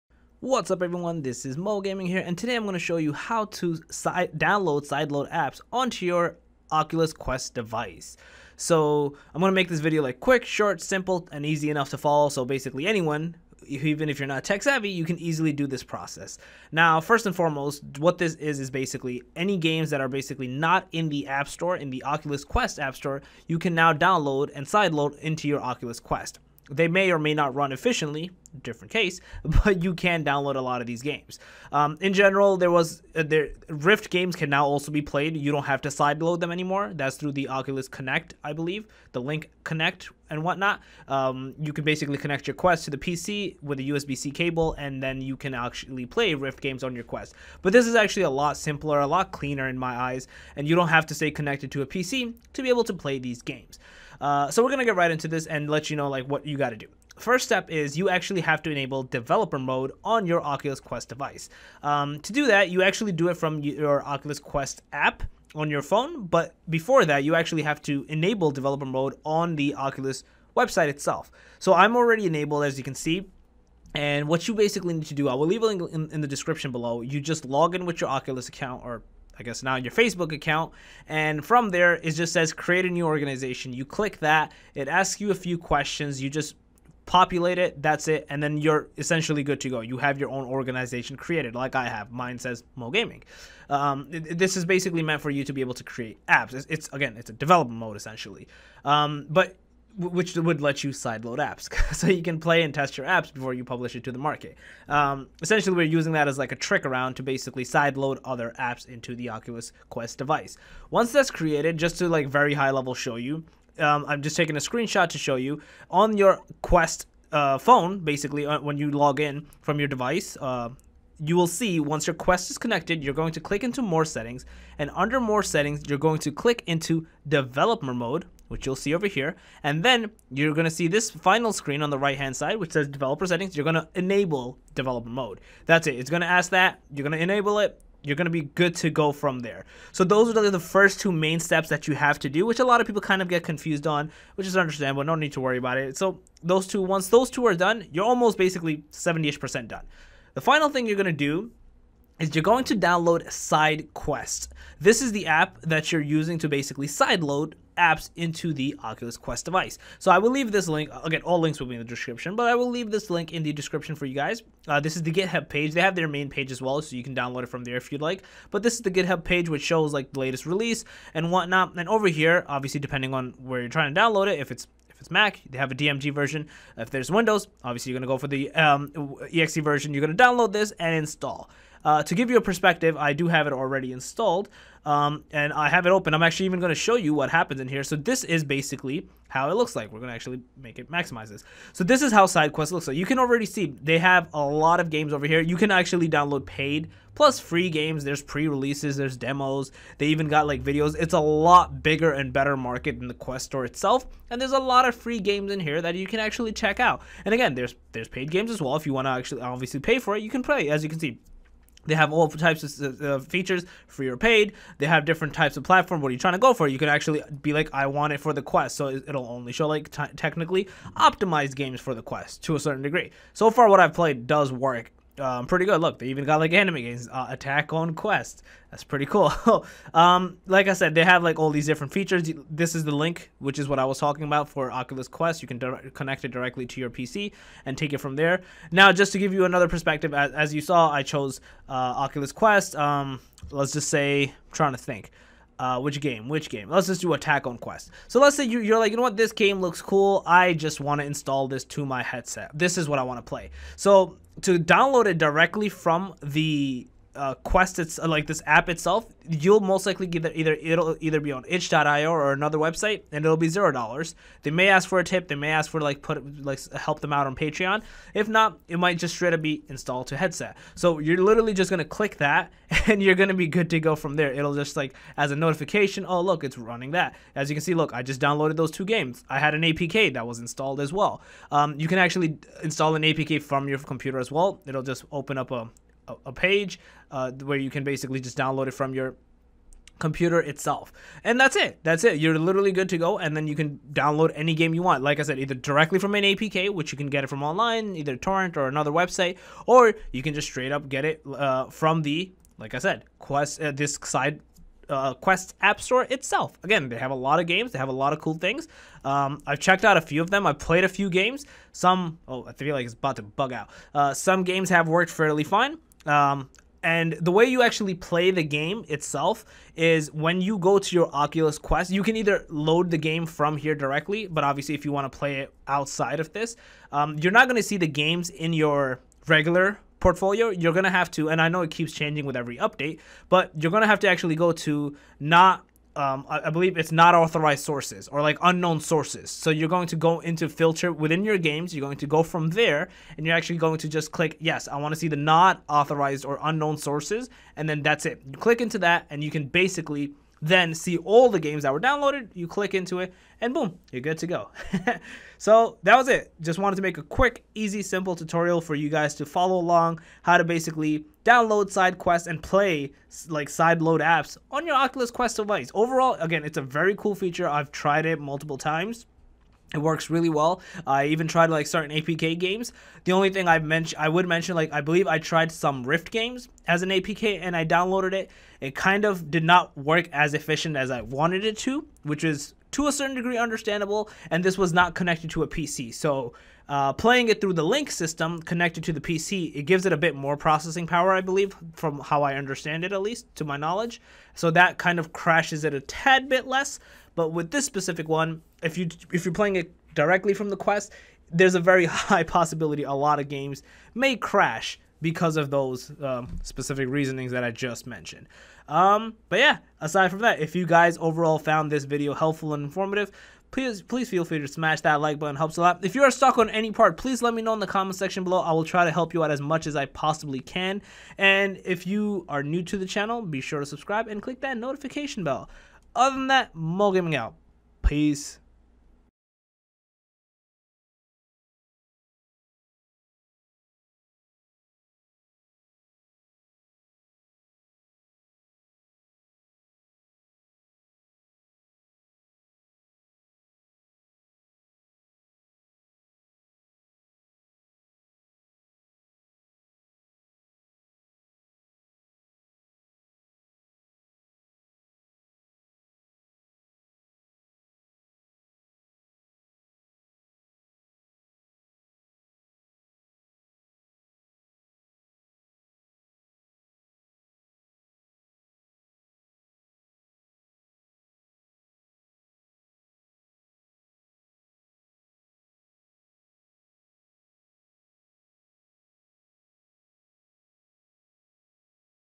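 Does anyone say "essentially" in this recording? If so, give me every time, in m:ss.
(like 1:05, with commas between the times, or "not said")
1:28, 1:37, 1:45.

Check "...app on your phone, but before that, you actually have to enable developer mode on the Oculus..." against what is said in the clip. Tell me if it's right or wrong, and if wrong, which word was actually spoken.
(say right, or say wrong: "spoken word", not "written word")
right.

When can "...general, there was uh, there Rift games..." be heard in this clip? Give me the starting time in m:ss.
0:32.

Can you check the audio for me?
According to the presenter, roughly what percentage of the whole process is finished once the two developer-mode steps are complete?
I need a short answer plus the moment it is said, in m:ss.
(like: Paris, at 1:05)
70 percent, at 2:28.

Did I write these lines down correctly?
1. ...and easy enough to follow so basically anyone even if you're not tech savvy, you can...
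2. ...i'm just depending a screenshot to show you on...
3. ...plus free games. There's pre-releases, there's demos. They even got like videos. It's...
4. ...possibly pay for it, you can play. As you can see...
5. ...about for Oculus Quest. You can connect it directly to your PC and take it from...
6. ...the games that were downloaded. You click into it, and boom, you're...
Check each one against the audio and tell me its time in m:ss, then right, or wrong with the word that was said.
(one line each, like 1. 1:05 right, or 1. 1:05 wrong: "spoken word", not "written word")
1. 0:11 right
2. 1:54 wrong: "taking", not "depending"
3. 3:17 right
4. 3:29 wrong: "obviously", not "possibly"
5. 3:54 right
6. 5:51 right.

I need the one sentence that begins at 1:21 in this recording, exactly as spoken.
And from there, it just says create a new organization.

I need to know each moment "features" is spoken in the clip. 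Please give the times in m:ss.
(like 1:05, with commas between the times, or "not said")
3:33, 3:51, 6:07.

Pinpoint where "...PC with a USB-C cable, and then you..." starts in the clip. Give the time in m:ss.
0:42.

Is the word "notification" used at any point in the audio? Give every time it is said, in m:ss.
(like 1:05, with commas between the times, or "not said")
4:35, 7:04.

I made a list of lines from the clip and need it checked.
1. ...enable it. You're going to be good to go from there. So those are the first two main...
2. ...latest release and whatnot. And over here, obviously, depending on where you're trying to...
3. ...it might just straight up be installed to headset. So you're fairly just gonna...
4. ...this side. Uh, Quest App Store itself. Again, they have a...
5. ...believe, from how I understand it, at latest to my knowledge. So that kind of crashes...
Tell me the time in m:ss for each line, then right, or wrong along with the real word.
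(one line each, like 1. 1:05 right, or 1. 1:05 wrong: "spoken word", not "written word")
1. 2:17 right
2. 2:50 right
3. 4:28 wrong: "literally", not "fairly"
4. 5:03 right
5. 6:31 wrong: "least", not "latest".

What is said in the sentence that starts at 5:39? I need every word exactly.
So you're going to go into filter within your games.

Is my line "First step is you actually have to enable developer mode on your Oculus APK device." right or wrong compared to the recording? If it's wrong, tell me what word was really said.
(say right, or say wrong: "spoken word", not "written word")
wrong: "Quest", not "APK".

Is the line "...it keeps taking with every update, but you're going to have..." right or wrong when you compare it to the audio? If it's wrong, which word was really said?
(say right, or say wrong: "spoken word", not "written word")
wrong: "changing", not "taking".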